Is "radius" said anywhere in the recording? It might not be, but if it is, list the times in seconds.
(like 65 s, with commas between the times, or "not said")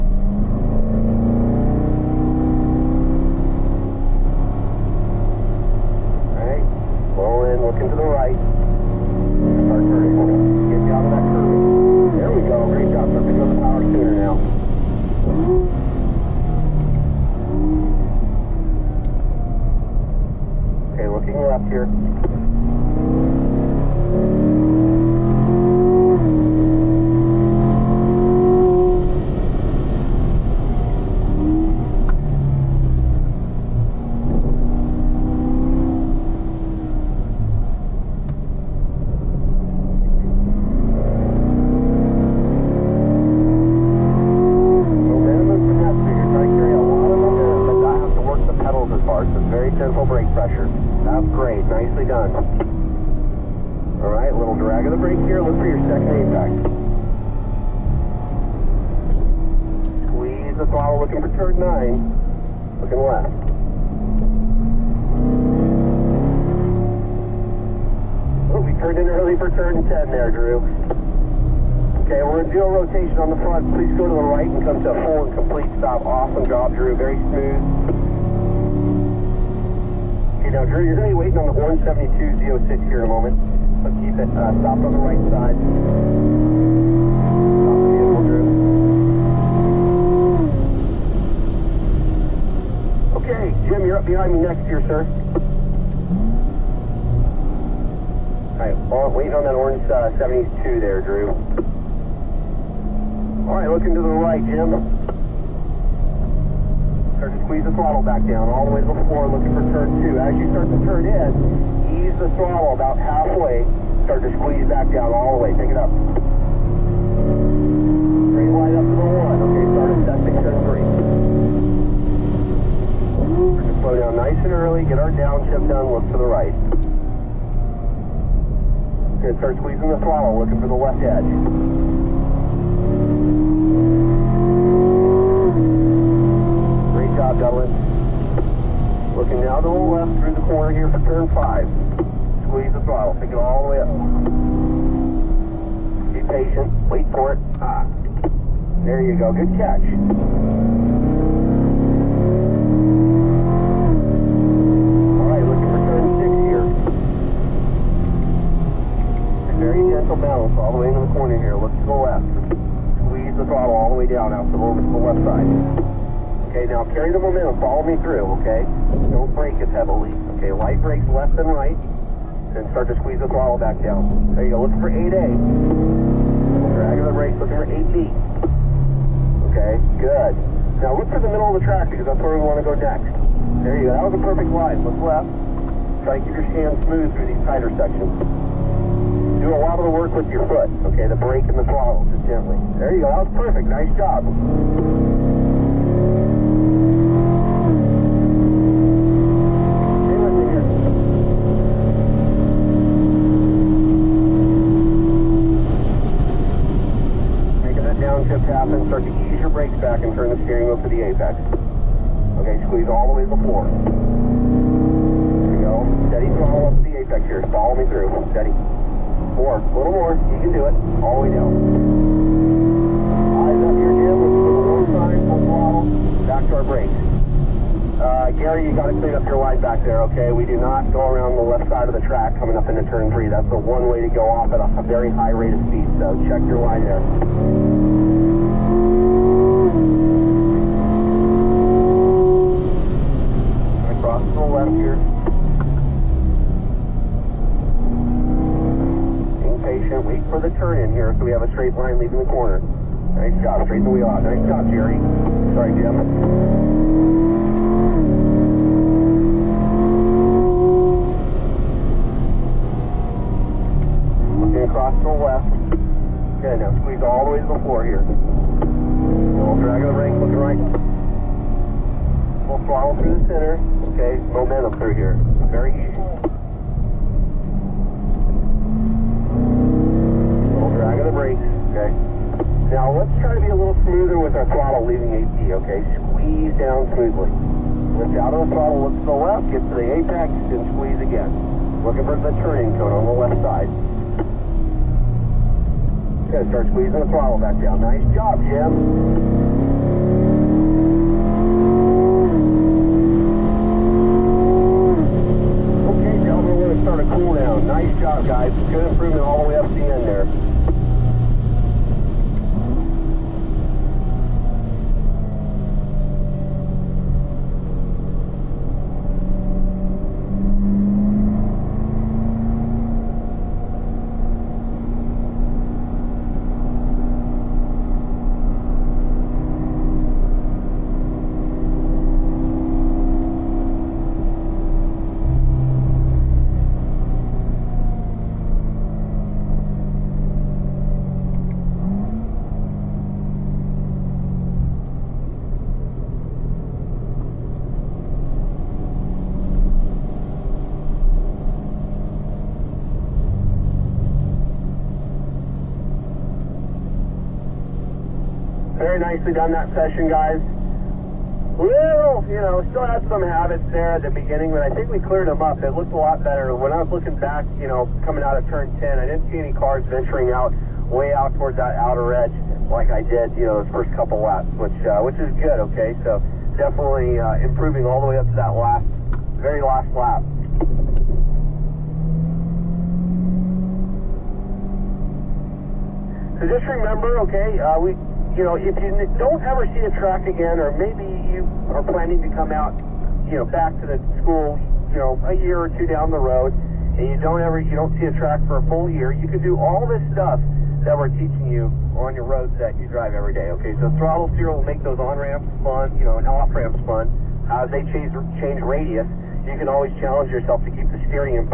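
408 s.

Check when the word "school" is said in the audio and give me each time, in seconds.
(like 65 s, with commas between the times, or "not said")
394 s.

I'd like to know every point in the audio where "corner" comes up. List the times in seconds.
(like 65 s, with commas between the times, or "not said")
140 s, 161 s, 252 s.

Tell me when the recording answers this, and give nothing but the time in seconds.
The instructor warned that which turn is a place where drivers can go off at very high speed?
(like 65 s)
232 s.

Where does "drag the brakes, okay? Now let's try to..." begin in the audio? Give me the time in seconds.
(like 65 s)
280 s.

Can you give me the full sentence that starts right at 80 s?
Okay, now Drew, you're going to be waiting on the 172 06 here in a moment.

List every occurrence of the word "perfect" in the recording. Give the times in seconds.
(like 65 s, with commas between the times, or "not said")
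184 s, 193 s.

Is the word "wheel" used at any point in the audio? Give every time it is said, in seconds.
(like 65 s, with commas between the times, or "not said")
210 s, 253 s.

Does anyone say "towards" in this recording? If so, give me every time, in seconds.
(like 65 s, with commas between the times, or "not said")
371 s.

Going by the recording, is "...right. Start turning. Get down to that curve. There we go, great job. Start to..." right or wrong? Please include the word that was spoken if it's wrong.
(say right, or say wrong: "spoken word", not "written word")
right.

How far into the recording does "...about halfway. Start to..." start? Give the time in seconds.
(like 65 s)
112 s.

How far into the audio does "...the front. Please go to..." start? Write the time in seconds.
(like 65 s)
73 s.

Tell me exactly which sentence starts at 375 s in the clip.
Okay, so definitely uh, improving all the way up to that last, very last lap.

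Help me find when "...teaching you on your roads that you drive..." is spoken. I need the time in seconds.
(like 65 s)
401 s.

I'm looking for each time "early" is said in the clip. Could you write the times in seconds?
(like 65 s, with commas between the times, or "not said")
69 s, 124 s.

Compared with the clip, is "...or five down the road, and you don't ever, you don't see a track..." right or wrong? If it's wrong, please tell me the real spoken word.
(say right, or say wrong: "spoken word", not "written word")
wrong: "two", not "five".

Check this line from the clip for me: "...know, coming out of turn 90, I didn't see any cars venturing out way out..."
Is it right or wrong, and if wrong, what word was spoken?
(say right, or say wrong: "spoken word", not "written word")
wrong: "10", not "90".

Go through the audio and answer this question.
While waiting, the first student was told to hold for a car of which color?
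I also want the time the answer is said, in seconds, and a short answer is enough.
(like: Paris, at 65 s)
Orange, at 99 s.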